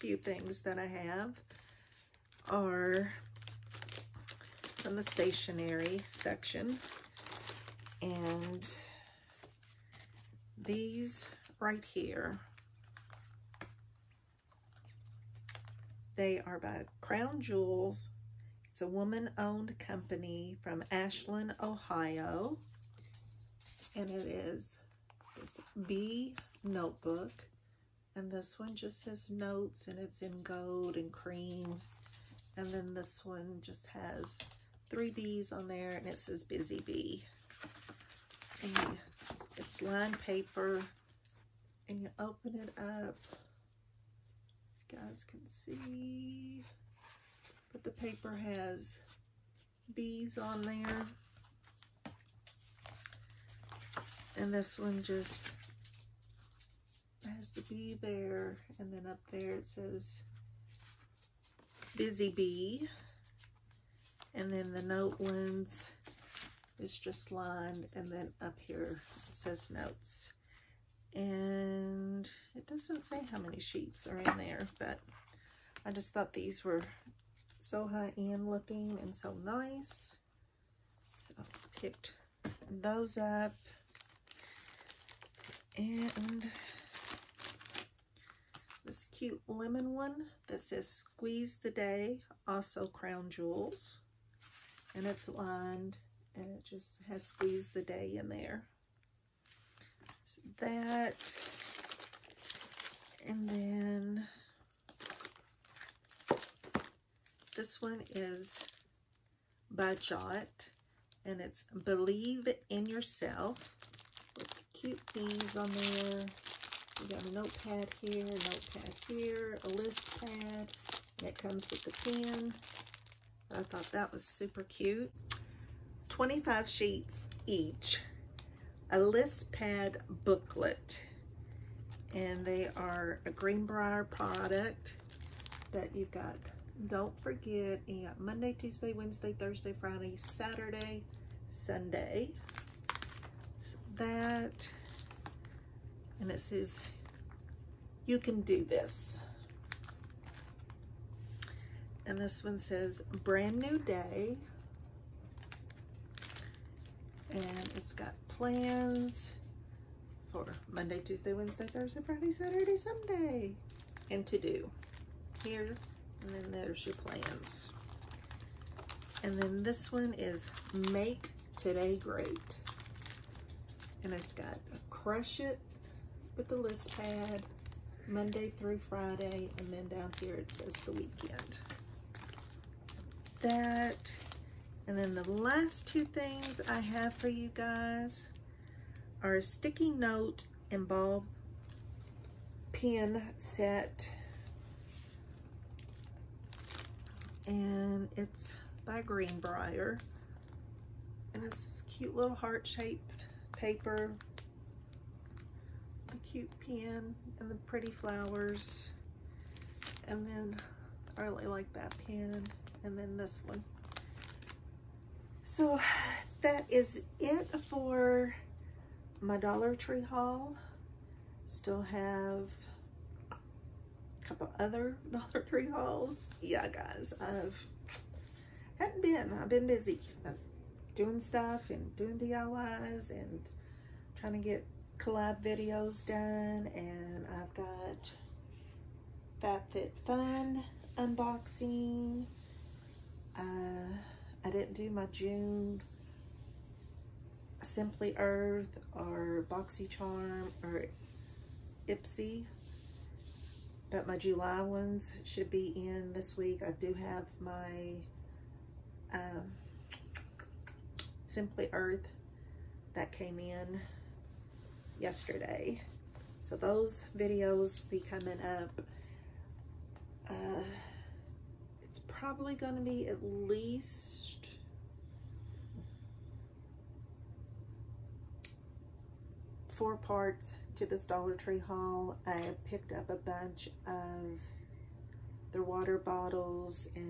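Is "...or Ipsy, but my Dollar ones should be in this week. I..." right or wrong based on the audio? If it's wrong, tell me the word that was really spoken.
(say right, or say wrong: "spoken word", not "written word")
wrong: "July", not "Dollar".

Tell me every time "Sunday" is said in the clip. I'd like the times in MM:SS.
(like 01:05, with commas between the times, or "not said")
02:21, 02:42.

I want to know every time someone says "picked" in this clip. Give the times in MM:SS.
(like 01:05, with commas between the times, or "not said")
01:21, 04:42.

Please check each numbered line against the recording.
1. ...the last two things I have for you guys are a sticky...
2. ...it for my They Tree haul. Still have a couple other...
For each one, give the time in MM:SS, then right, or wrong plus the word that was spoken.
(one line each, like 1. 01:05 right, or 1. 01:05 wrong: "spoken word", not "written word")
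1. 03:05 right
2. 03:37 wrong: "Dollar", not "They".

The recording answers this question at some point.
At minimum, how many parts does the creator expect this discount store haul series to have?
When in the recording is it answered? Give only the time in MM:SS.
04:39.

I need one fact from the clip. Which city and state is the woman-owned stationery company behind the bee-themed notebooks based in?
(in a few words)
Ashland, Ohio.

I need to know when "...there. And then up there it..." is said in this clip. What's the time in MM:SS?
00:58.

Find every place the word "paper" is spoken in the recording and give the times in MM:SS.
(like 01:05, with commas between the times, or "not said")
00:40, 00:47, 03:23.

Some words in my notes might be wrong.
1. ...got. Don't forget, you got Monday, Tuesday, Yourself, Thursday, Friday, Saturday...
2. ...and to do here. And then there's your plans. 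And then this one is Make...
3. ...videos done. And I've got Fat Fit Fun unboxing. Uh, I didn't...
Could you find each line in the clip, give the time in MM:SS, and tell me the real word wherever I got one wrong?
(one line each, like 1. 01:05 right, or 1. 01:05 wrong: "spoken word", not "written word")
1. 02:16 wrong: "Wednesday", not "Yourself"
2. 02:44 right
3. 03:55 right.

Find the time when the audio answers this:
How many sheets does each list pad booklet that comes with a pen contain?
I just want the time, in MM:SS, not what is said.
02:06.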